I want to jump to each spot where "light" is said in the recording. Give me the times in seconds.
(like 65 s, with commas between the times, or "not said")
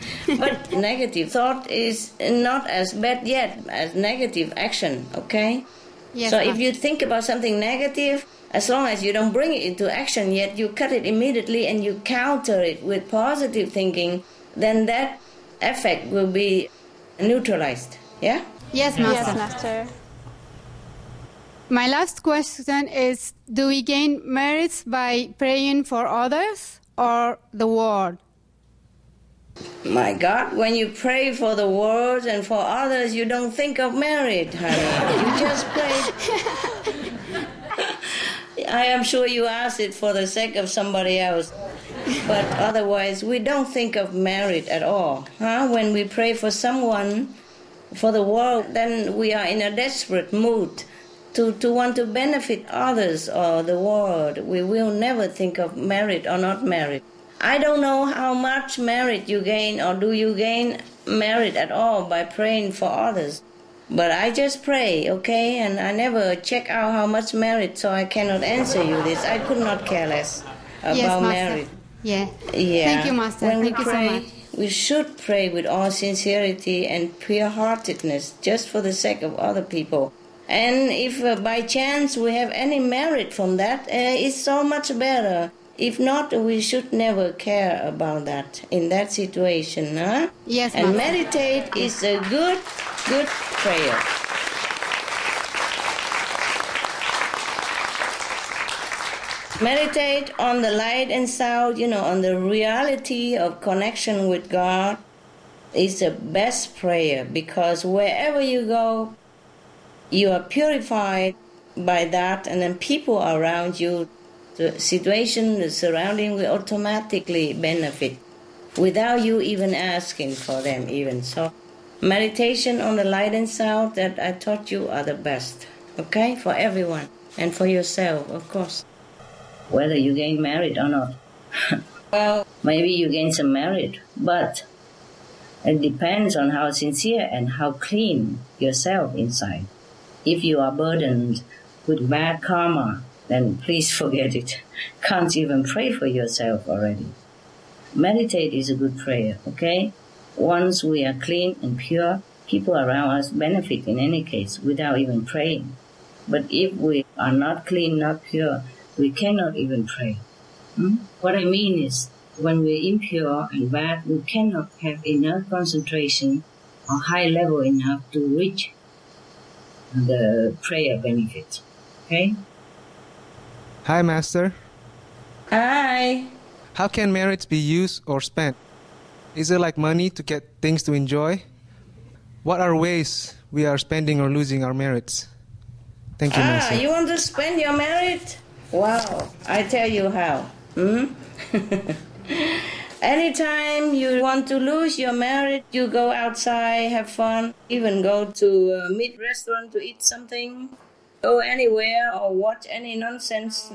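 100 s, 123 s.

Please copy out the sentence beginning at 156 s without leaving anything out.
But if we are not clean, not pure, we cannot even pray.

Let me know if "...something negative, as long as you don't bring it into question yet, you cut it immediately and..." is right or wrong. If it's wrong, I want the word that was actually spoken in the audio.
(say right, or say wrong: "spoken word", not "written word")
wrong: "action", not "question".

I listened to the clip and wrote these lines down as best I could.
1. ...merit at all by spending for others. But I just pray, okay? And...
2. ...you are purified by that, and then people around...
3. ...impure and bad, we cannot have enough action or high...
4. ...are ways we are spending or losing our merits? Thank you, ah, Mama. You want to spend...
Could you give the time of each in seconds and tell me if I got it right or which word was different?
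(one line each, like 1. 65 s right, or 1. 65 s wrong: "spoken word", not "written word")
1. 61 s wrong: "praying", not "spending"
2. 110 s right
3. 162 s wrong: "concentration", not "action"
4. 182 s wrong: "Master", not "Mama".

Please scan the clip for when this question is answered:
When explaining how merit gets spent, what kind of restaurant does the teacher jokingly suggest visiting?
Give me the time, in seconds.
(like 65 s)
198 s.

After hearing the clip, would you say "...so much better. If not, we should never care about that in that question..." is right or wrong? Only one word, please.
wrong.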